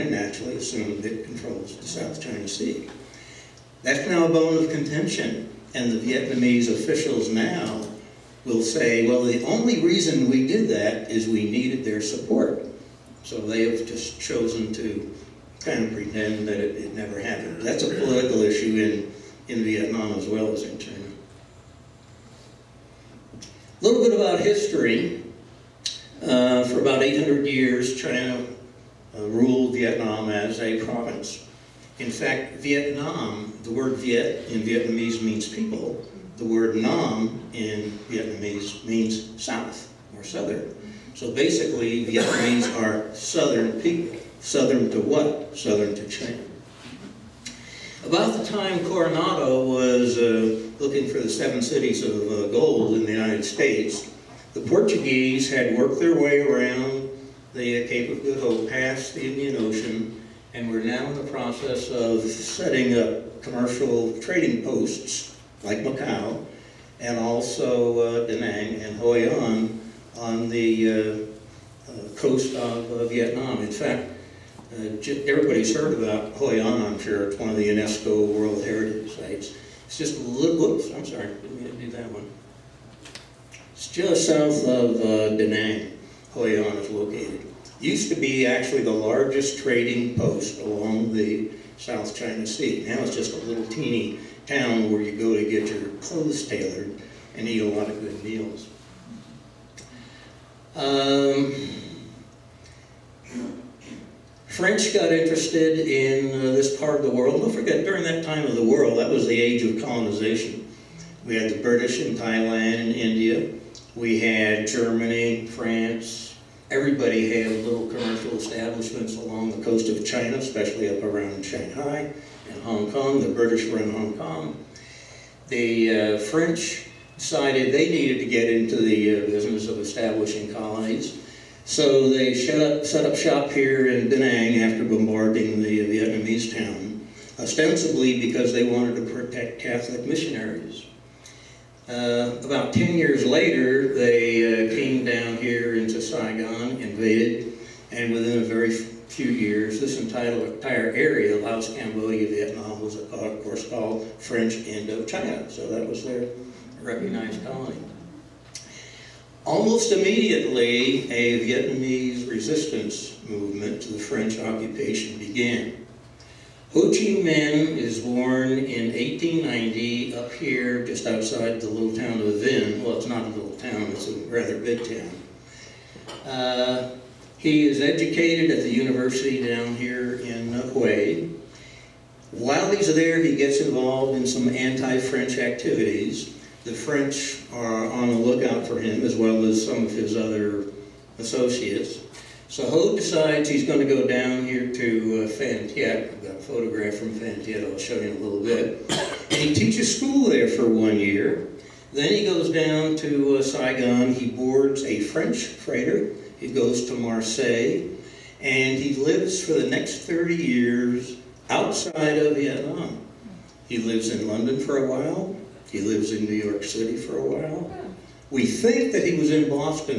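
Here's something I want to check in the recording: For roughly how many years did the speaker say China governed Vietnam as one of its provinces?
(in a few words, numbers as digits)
800.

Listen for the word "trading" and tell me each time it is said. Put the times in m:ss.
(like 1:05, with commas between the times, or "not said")
1:04, 1:29.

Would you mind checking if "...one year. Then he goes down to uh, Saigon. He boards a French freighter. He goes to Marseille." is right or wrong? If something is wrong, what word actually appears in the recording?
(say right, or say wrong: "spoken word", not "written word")
right.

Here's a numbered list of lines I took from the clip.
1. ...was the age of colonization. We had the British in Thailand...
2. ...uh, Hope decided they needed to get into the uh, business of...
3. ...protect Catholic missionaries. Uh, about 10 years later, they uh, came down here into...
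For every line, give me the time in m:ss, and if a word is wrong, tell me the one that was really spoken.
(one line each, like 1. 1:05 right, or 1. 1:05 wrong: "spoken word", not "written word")
1. 1:49 right
2. 2:06 wrong: "French", not "Hope"
3. 2:19 right.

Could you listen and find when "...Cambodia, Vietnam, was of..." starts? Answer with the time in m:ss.
2:31.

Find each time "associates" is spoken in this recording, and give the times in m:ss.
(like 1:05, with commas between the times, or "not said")
3:11.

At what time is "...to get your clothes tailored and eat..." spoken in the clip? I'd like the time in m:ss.
1:35.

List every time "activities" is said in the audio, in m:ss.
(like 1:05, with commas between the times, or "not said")
3:05.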